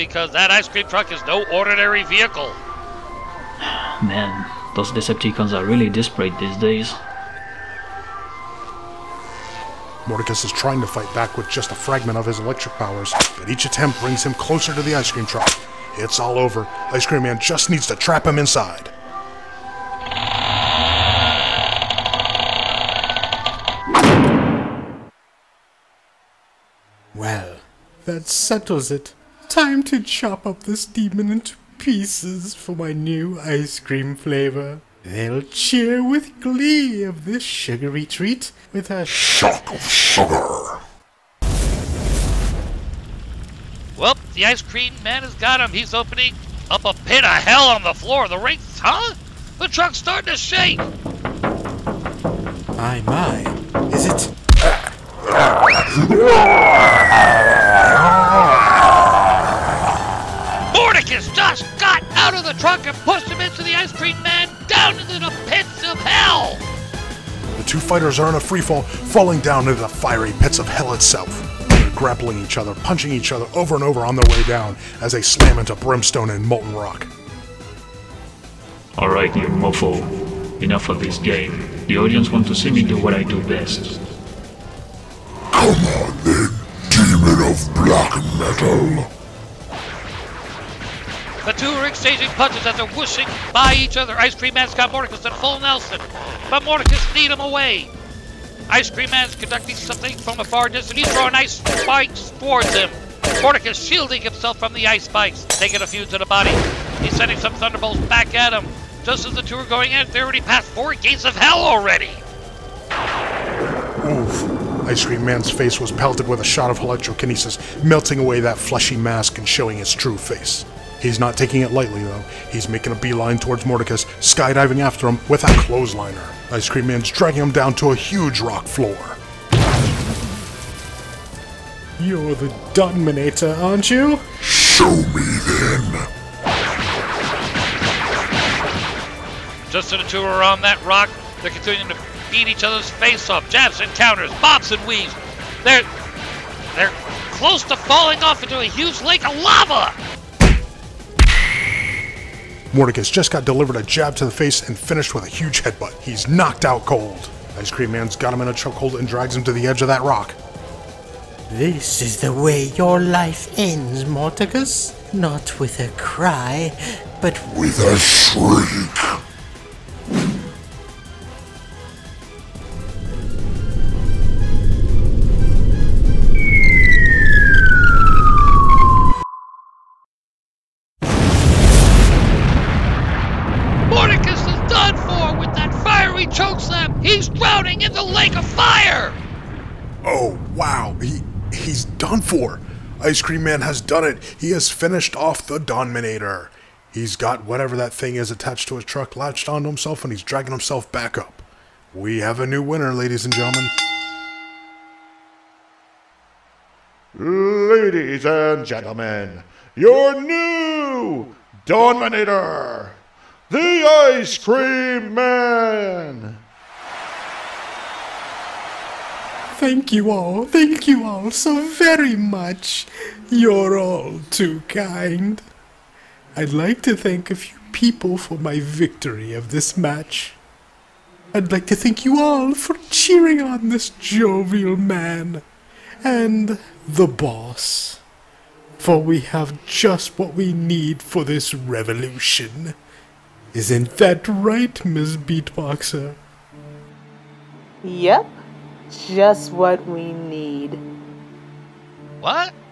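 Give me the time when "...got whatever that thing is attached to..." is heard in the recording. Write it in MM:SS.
03:17.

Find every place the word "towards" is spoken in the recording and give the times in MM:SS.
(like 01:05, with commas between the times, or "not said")
01:42, 02:03.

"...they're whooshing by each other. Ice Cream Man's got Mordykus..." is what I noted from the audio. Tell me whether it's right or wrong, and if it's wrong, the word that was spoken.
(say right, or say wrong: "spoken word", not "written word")
right.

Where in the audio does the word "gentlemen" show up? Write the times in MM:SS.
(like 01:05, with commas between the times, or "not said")
03:23, 03:28.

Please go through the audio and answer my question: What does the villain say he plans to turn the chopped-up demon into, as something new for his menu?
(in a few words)
new ice cream flavor.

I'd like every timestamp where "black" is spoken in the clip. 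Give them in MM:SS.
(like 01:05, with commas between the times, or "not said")
01:27.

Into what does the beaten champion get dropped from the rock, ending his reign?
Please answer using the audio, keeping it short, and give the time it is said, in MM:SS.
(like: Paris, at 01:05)
lake of fire, at 03:08.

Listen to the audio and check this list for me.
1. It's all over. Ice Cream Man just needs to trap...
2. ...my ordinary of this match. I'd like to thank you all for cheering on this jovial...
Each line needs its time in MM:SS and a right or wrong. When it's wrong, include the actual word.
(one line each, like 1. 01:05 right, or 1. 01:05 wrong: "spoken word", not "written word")
1. 00:15 right
2. 03:48 wrong: "victory", not "ordinary".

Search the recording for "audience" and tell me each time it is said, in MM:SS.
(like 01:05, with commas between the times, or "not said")
01:21.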